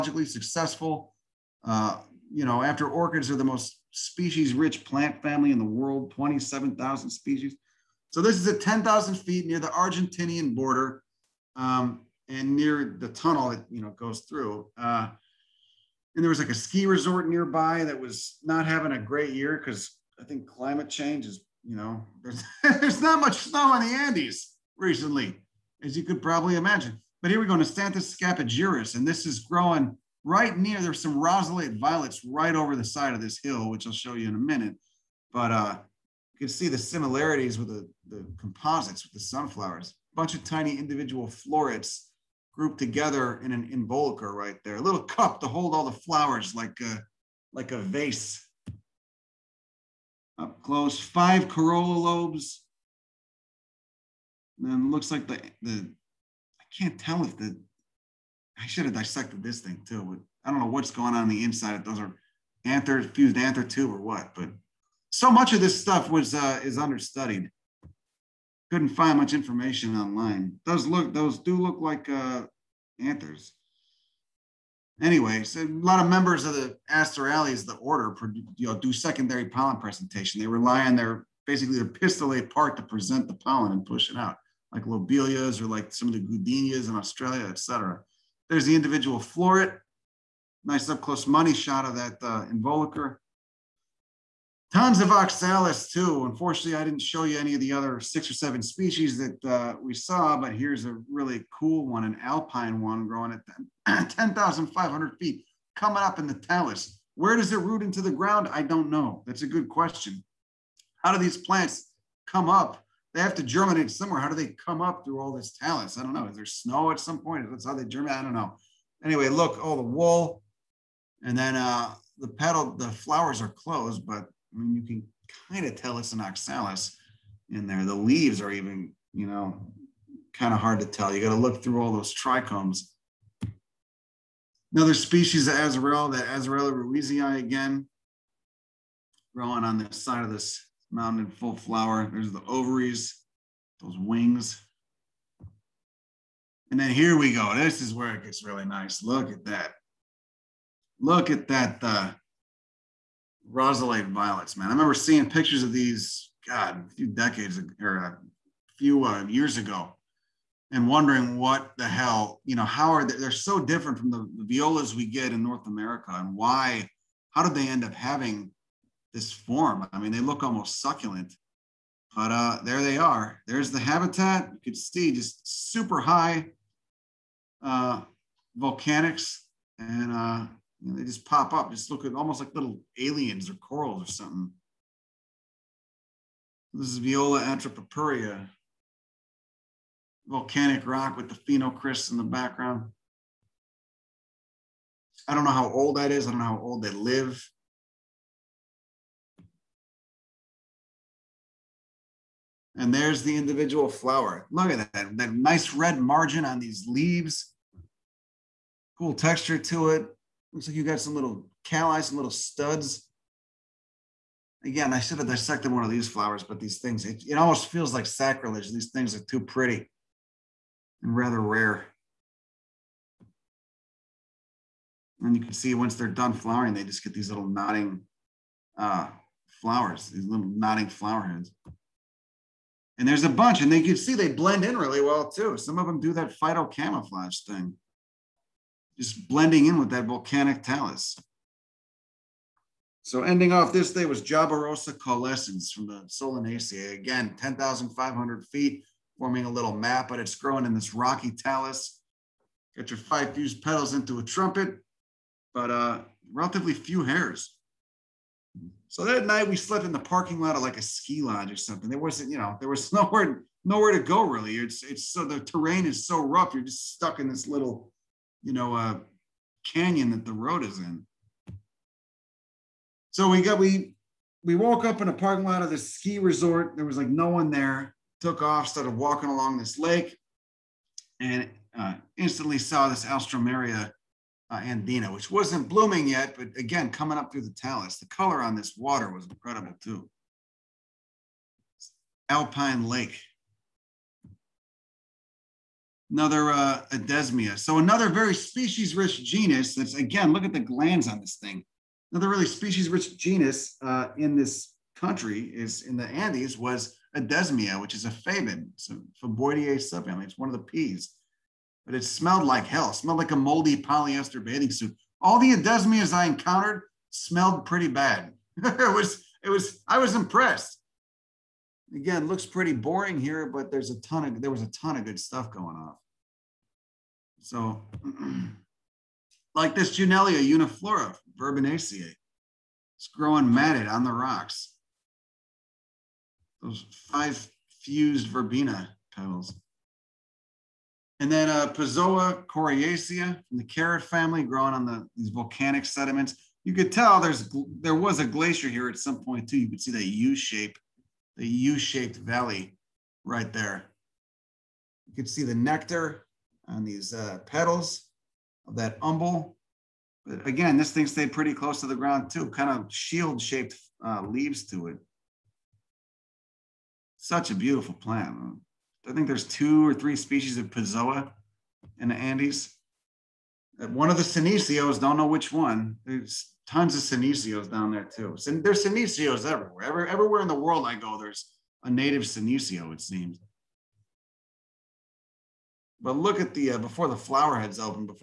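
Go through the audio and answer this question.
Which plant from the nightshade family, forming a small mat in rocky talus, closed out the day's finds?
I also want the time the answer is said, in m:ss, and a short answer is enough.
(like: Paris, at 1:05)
Jaborosa caulescens, at 4:04.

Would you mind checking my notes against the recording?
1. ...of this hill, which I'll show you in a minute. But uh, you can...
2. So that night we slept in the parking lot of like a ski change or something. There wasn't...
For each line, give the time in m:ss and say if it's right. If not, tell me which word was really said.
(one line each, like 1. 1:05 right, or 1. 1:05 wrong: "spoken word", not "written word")
1. 0:33 right
2. 4:18 wrong: "lodge", not "change".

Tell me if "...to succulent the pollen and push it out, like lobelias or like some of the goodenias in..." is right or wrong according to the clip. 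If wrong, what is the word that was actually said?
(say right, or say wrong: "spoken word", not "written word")
wrong: "present", not "succulent".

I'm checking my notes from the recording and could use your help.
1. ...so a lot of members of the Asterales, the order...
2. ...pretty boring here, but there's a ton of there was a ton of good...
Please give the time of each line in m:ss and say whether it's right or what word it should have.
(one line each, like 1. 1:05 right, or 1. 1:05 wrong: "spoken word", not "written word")
1. 1:15 right
2. 5:22 right.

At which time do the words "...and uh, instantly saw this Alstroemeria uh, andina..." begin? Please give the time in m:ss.
4:41.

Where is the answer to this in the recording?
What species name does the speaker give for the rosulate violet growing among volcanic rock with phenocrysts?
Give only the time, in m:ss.
3:06.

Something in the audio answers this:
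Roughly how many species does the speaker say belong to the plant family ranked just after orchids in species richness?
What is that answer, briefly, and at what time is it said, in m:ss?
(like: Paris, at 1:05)
27,000, at 0:06.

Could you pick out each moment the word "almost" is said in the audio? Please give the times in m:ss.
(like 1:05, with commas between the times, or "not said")
2:50, 3:02, 3:37.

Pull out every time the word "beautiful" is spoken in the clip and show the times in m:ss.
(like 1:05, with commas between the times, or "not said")
6:07.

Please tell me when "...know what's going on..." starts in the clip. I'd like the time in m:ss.
1:00.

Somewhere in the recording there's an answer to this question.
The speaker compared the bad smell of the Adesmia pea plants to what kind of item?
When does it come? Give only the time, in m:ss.
5:13.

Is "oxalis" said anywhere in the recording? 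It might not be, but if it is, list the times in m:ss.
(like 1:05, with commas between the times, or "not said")
1:35, 2:06.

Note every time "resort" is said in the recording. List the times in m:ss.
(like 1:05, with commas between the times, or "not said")
0:16, 4:36.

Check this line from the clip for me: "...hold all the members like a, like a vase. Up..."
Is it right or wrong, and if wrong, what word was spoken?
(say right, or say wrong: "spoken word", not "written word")
wrong: "flowers", not "members".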